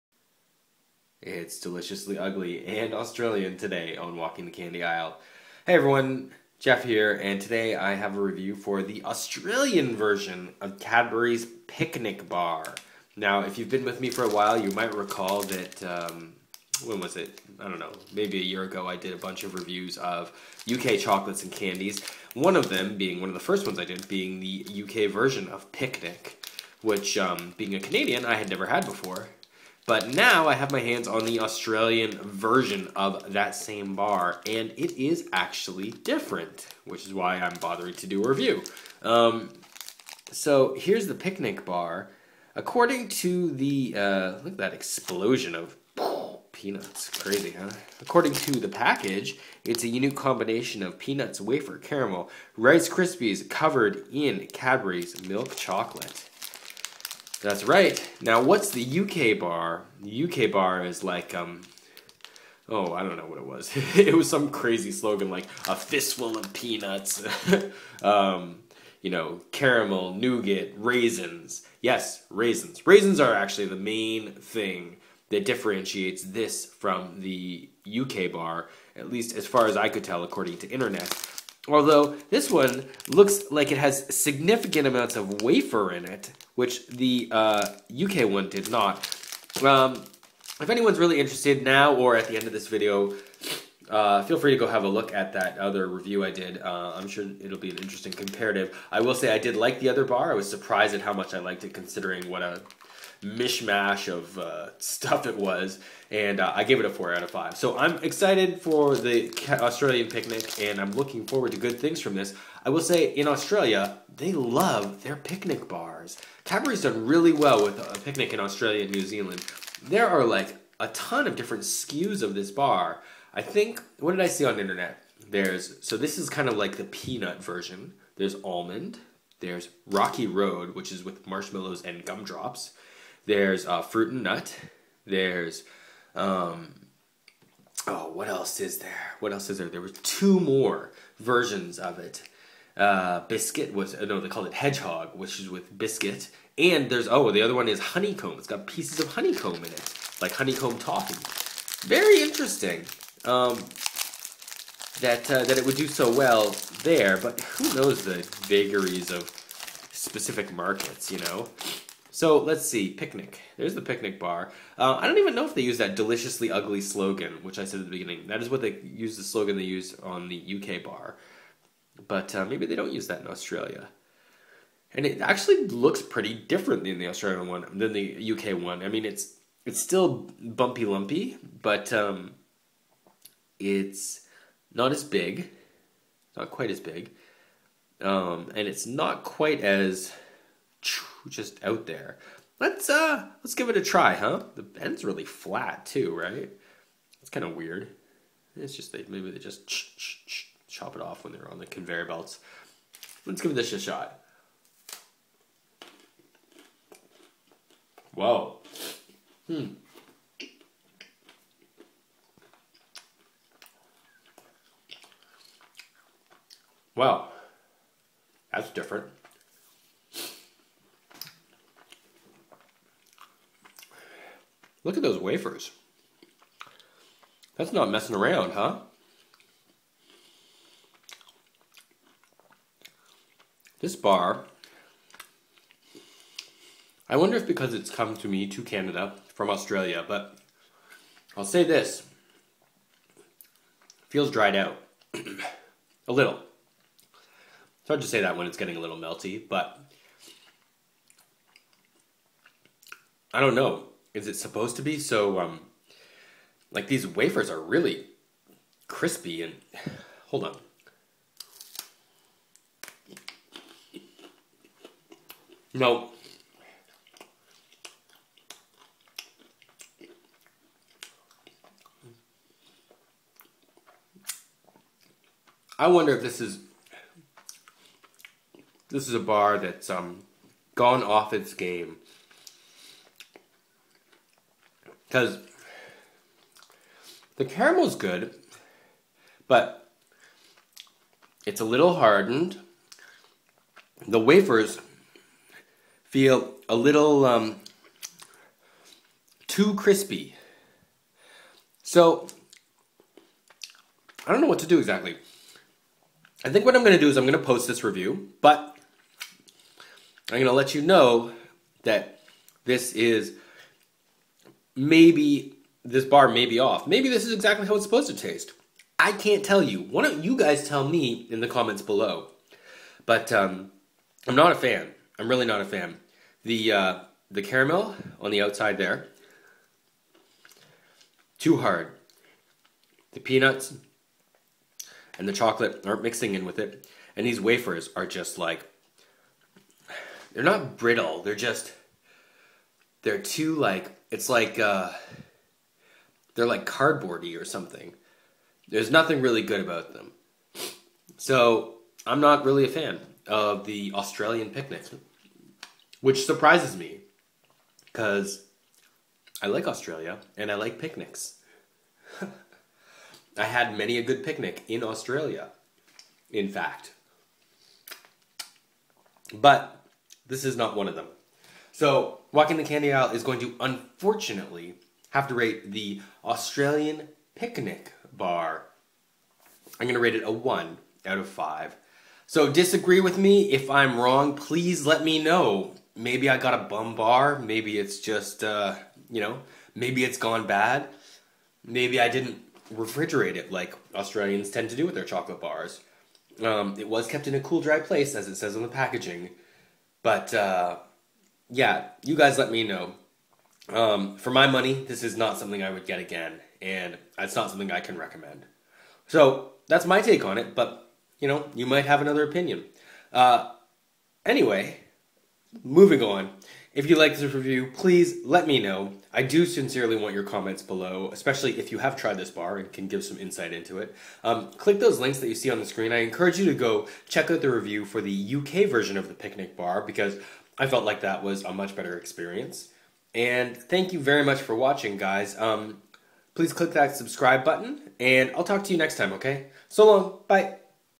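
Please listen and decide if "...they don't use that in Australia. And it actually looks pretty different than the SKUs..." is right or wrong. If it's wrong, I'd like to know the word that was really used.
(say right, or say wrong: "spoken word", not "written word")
wrong: "Australian", not "SKUs".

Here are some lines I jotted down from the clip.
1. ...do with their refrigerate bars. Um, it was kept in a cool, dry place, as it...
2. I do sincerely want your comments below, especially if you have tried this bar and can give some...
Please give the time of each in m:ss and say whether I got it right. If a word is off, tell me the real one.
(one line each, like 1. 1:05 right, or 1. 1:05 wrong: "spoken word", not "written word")
1. 6:34 wrong: "chocolate", not "refrigerate"
2. 6:59 right.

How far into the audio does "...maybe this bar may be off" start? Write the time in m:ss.
5:14.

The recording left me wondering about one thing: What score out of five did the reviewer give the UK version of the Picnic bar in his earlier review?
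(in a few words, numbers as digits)
4.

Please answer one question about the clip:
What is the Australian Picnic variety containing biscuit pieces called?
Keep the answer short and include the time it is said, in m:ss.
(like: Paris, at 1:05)
Hedgehog, at 2:24.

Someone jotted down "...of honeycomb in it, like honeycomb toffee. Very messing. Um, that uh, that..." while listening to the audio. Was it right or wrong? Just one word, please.
wrong.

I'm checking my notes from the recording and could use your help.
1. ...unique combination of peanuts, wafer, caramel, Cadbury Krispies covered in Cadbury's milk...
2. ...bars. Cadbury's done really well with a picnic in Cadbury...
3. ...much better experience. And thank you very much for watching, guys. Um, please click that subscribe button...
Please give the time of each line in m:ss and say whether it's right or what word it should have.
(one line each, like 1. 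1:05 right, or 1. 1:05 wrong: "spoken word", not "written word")
1. 0:49 wrong: "Rice", not "Cadbury"
2. 1:55 wrong: "Australia", not "Cadbury"
3. 7:11 right.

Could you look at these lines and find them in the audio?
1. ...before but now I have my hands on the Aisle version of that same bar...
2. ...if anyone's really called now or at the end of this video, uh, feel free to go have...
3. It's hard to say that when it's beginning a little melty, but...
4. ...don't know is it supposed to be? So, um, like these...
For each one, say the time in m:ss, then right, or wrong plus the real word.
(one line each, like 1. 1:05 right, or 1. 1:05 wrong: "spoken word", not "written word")
1. 0:28 wrong: "Australian", not "Aisle"
2. 1:30 wrong: "interested", not "called"
3. 4:07 wrong: "getting", not "beginning"
4. 4:13 right.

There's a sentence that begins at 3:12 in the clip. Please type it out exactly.
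Let's uh let's give it a try, huh?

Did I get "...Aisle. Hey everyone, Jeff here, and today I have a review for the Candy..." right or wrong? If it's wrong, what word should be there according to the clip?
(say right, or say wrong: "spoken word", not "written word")
wrong: "Australian", not "Candy".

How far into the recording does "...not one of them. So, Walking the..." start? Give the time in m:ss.
6:10.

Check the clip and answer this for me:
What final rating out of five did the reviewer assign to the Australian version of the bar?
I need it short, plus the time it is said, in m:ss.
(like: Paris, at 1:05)
1, at 6:20.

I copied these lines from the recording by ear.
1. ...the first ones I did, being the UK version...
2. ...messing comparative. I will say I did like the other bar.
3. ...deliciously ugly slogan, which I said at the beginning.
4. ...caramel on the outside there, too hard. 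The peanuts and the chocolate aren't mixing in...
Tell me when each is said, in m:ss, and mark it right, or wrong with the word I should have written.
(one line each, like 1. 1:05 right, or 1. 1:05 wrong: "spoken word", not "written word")
1. 0:23 right
2. 1:37 wrong: "interesting", not "messing"
3. 2:45 right
4. 5:27 right.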